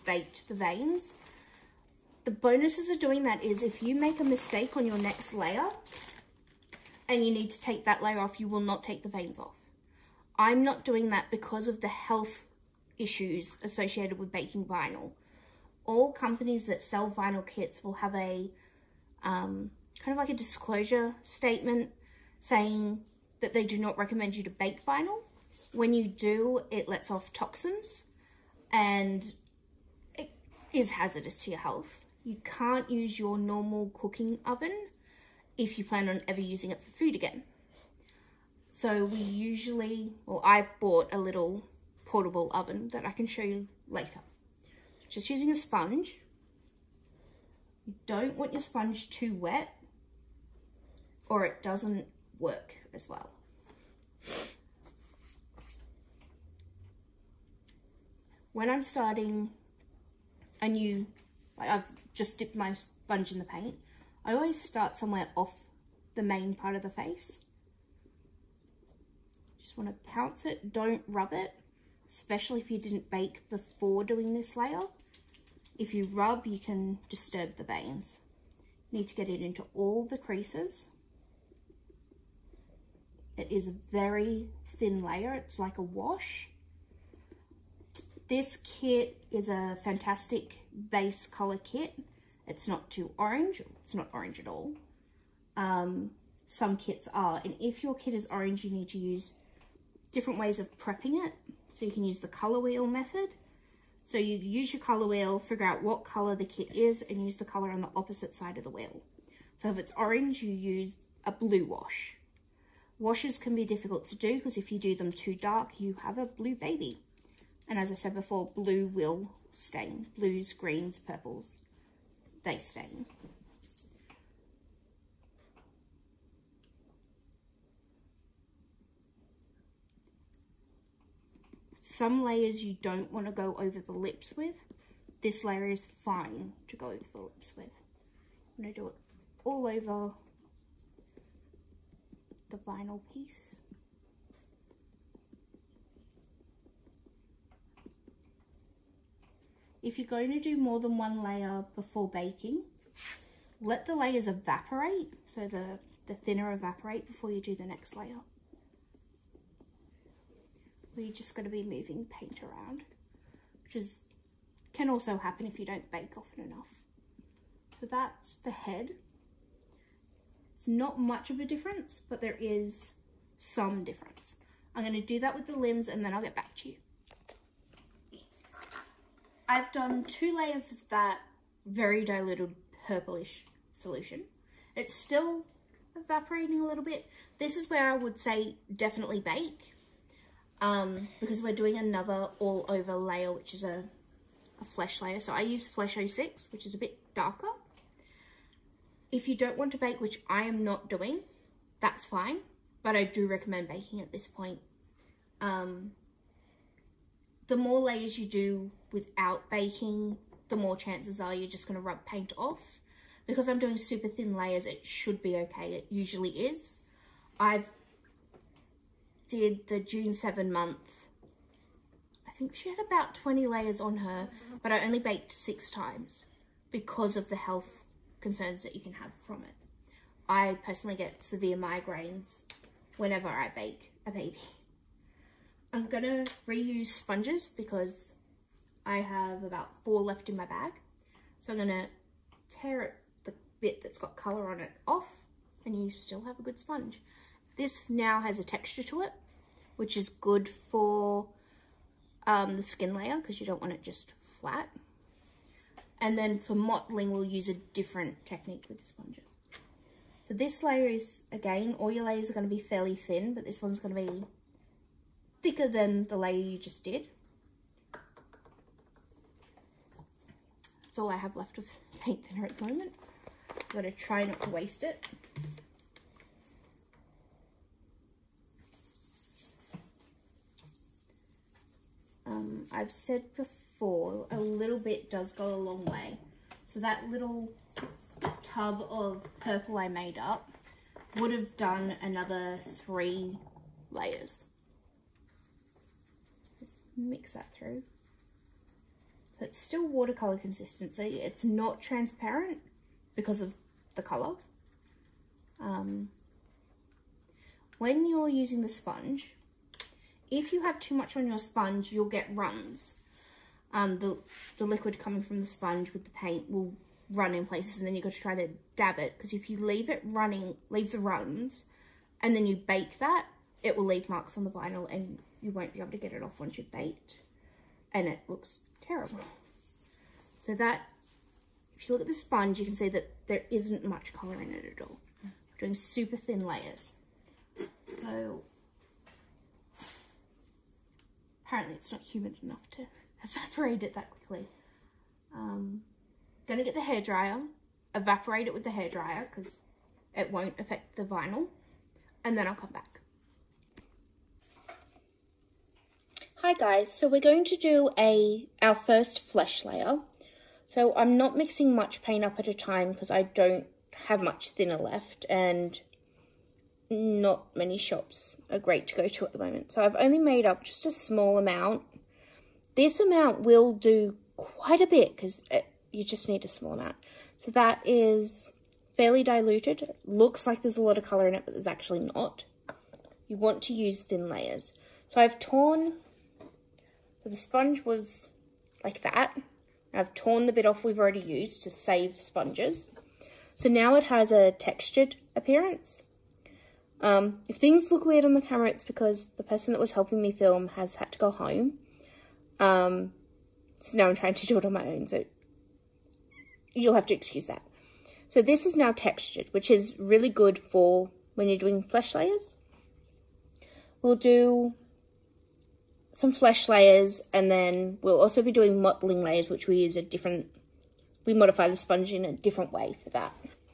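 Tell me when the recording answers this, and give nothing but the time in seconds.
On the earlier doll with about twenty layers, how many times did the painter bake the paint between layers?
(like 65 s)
224 s.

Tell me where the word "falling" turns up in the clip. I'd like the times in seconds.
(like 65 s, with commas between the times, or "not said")
not said.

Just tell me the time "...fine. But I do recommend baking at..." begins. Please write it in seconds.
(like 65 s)
202 s.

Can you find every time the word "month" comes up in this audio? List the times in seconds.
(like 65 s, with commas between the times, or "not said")
220 s.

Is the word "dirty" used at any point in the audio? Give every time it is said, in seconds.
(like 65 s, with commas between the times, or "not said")
not said.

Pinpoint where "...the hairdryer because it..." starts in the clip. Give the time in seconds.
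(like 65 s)
348 s.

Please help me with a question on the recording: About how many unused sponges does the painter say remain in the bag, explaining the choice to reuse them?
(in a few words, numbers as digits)
4.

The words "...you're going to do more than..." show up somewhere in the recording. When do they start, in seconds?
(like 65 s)
149 s.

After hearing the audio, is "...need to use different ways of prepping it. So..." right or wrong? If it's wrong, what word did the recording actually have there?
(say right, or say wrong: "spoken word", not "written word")
right.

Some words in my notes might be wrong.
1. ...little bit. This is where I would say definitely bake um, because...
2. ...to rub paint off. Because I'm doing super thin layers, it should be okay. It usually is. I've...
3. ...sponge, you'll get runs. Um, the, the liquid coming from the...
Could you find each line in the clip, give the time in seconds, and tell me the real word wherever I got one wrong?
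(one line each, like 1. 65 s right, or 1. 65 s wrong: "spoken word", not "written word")
1. 186 s right
2. 211 s right
3. 311 s right.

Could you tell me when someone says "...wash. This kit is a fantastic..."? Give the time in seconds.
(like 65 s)
85 s.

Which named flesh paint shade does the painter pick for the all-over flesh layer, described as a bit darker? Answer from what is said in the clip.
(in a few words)
Flesh 06.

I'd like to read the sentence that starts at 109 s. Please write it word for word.
So if it's orange, you use a blue wash.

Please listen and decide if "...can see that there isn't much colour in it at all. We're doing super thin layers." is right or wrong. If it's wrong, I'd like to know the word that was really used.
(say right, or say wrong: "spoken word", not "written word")
right.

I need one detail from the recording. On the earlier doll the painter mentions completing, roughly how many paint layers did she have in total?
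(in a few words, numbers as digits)
20.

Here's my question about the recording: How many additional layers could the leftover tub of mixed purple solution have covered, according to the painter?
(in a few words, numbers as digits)
3.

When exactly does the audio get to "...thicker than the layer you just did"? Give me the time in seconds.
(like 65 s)
265 s.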